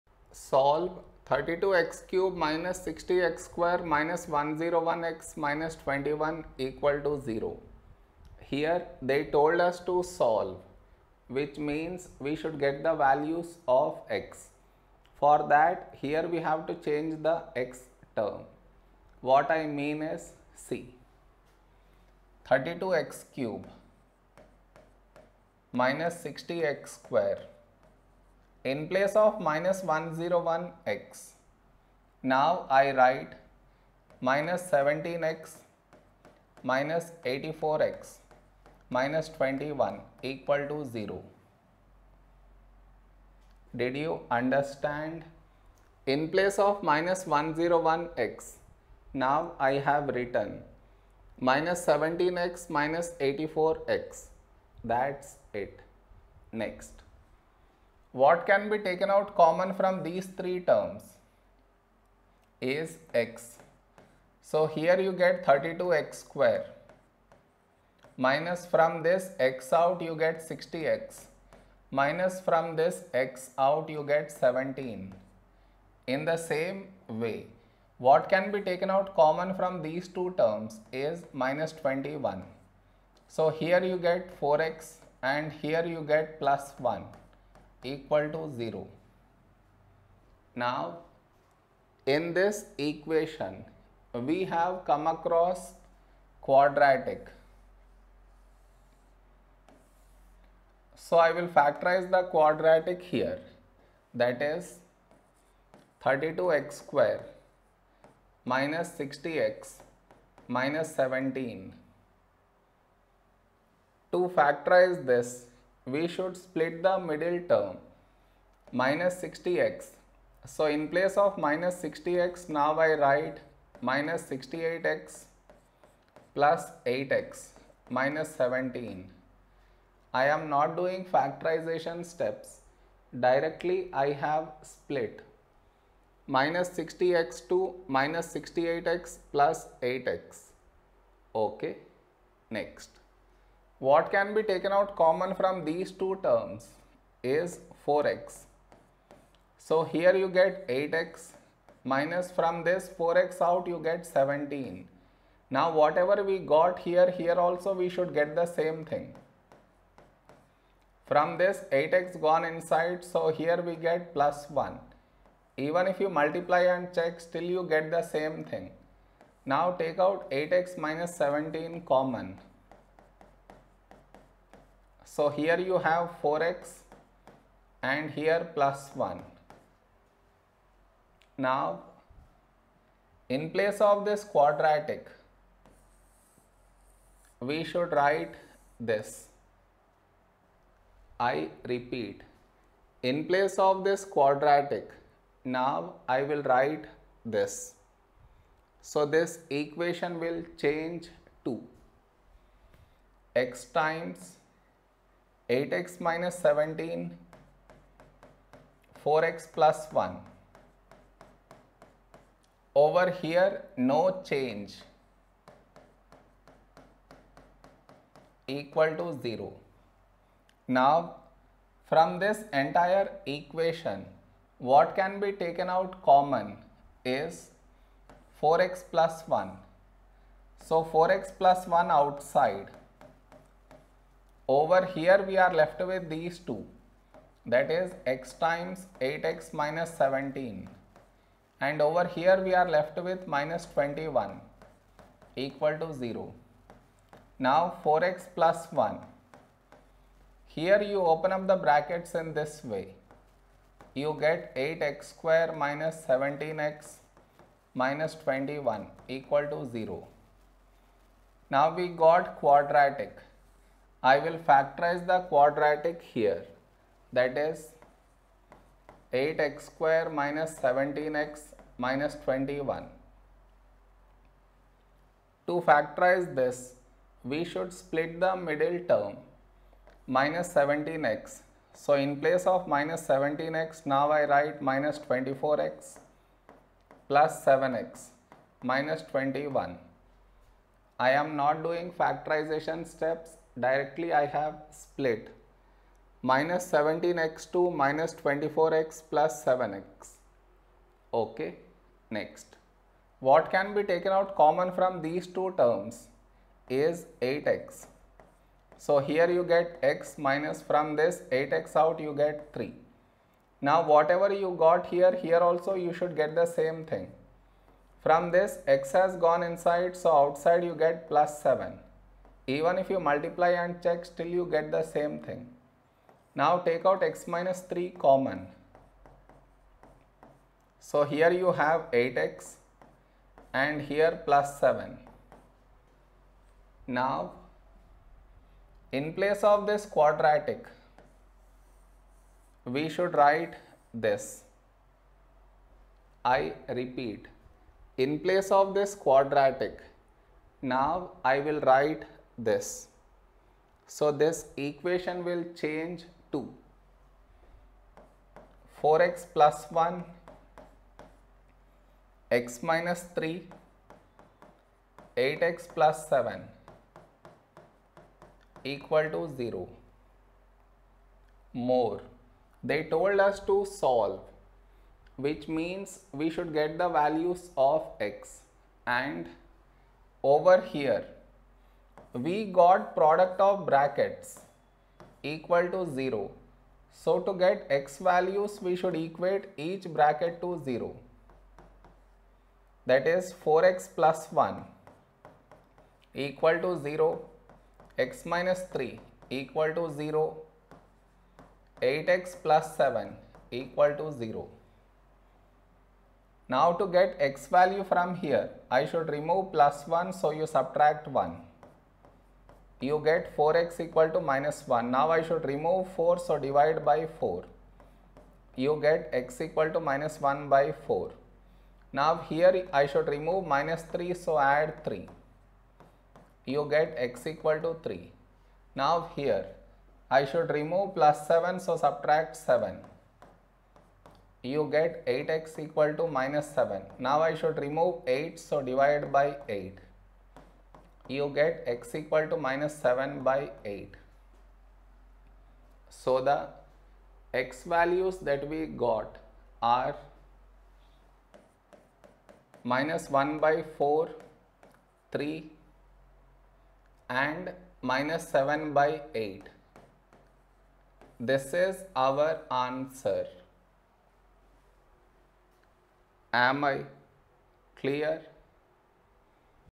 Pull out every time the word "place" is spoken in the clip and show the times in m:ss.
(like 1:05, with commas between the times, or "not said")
0:28, 0:46, 2:00, 3:03, 3:13, 4:42, 5:39, 5:48.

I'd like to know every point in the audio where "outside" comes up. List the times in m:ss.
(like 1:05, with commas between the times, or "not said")
3:51, 5:20.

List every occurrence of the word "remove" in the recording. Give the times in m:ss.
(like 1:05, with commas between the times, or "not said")
6:49, 6:55, 7:03, 7:10, 7:17.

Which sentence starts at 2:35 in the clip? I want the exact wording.
Now whatever we got here, here also we should get the same thing.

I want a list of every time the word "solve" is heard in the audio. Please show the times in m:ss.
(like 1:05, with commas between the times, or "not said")
0:00, 0:10, 6:13.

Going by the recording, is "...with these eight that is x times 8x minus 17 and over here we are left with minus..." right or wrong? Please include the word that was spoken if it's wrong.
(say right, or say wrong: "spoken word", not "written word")
wrong: "two", not "eight".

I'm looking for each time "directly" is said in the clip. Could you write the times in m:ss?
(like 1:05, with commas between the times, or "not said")
2:13, 4:53.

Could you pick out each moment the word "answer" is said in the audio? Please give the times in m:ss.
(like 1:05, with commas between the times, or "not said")
7:42.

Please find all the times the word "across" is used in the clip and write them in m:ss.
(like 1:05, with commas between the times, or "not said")
1:35.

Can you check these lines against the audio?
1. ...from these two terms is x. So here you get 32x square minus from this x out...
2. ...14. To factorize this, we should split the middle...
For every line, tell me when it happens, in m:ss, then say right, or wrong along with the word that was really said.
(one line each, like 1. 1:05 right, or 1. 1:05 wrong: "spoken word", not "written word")
1. 0:59 wrong: "three", not "two"
2. 1:50 wrong: "17", not "14".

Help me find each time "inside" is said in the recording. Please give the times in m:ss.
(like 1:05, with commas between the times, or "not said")
2:42, 5:19.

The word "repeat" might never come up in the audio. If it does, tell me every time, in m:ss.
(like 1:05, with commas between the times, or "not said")
3:11, 5:46.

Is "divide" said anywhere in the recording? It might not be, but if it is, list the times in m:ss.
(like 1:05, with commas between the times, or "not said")
6:56, 7:18.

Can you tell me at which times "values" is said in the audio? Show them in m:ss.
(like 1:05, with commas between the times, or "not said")
0:12, 6:16, 6:27, 6:47, 7:27.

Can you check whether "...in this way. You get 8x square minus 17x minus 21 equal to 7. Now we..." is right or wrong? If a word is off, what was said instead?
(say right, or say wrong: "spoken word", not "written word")
wrong: "0", not "7".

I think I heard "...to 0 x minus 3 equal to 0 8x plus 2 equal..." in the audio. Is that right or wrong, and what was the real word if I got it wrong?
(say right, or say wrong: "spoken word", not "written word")
wrong: "7", not "2".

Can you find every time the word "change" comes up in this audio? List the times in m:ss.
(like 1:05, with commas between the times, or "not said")
0:16, 3:20, 3:34, 5:55.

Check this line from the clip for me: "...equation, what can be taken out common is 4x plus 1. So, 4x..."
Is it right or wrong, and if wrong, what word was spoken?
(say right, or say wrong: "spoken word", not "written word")
right.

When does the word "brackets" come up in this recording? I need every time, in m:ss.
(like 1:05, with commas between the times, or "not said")
4:11, 6:23, 6:29.